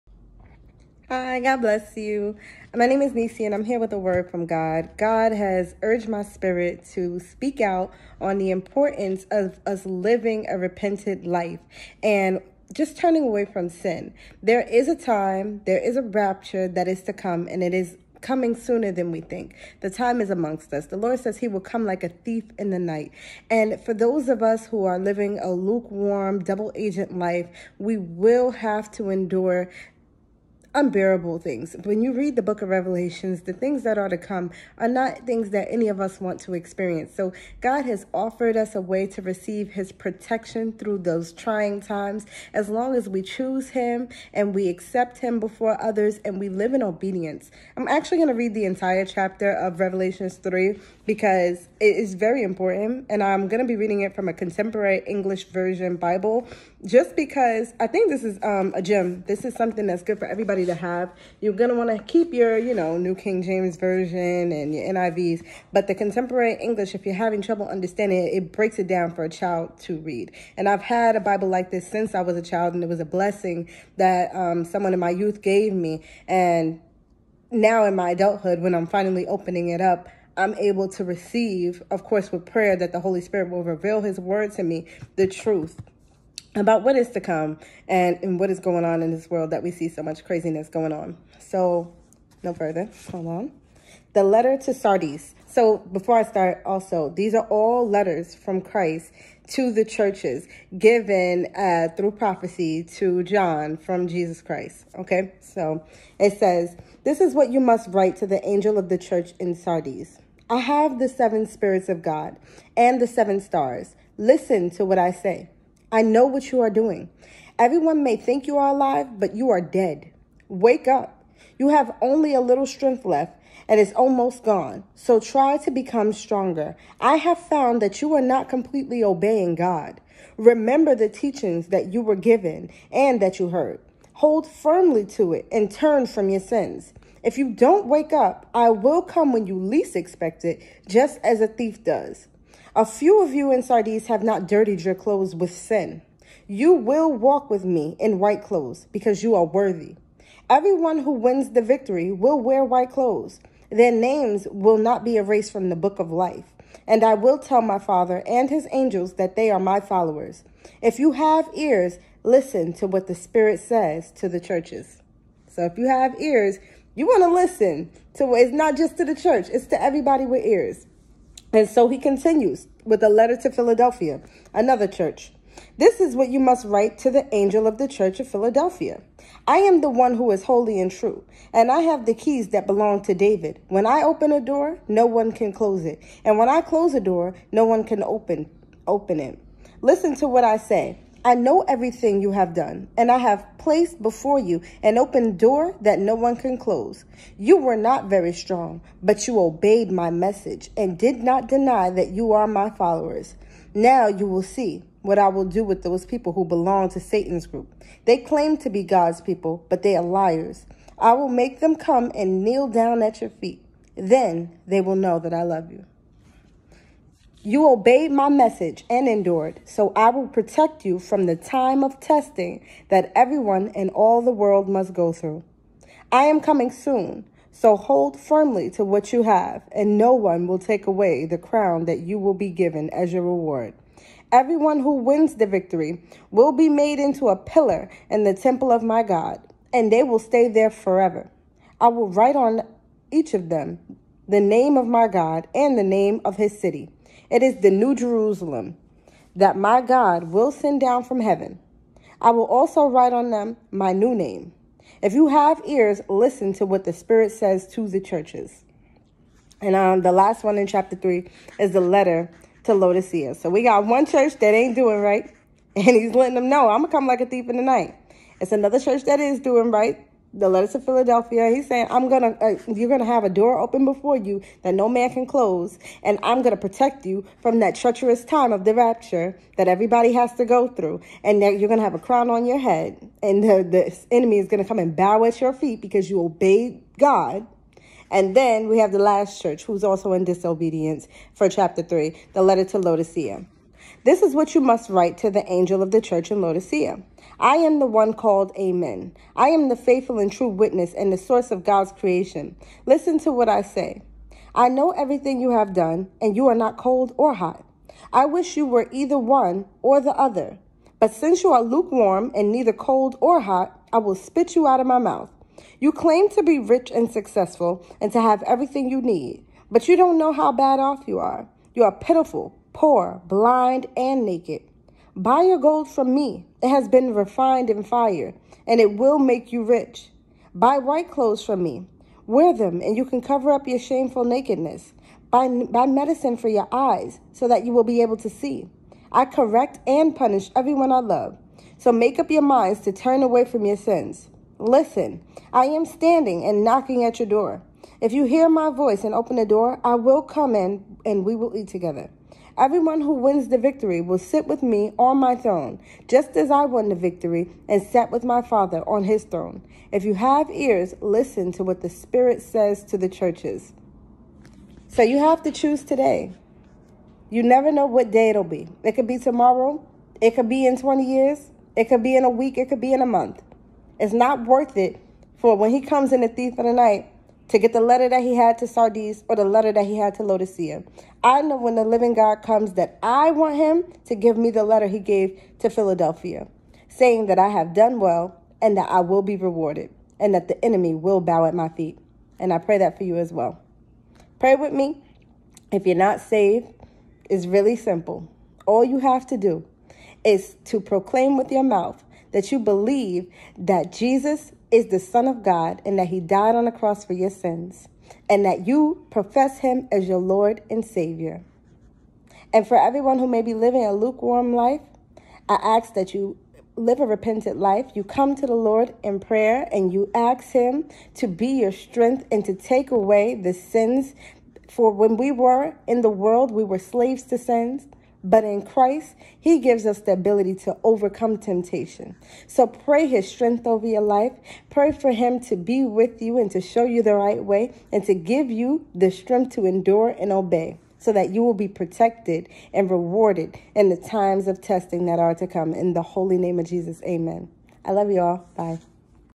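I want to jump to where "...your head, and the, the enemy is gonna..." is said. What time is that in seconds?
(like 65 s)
282 s.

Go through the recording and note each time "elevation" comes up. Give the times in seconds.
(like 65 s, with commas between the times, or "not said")
not said.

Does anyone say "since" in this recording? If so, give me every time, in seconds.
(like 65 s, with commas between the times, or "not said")
71 s, 311 s.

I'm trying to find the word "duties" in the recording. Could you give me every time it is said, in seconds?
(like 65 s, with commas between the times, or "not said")
not said.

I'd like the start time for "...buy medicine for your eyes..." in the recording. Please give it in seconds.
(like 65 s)
335 s.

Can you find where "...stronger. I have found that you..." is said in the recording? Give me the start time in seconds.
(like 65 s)
126 s.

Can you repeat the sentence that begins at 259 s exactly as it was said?
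And um, the last one in chapter 3 is the letter to Laodicea.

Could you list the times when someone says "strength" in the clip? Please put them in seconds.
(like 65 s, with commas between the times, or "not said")
122 s, 421 s, 433 s, 439 s.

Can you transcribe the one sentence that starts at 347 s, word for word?
If you hear my voice and open the door, I will come in and we will eat together.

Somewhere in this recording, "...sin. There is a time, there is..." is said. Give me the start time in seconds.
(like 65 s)
13 s.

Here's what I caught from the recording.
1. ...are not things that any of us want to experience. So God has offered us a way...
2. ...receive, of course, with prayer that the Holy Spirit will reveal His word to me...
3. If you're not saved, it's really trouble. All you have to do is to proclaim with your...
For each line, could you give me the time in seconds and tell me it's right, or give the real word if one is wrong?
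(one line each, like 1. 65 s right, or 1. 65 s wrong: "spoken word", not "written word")
1. 34 s right
2. 81 s right
3. 395 s wrong: "simple", not "trouble".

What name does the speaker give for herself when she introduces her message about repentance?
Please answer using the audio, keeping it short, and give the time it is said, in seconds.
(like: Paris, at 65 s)
Nisi, at 3 s.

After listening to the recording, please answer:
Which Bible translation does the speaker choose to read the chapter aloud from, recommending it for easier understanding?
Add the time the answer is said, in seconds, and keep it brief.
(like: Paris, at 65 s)
Contemporary English Version, at 54 s.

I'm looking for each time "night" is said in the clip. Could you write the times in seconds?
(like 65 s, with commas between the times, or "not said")
22 s, 267 s, 376 s.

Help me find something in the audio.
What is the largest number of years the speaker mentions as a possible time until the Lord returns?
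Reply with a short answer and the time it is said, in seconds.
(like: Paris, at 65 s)
20, at 370 s.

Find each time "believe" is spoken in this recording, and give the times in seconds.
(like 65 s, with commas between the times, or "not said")
402 s.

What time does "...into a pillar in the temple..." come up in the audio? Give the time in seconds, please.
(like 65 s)
236 s.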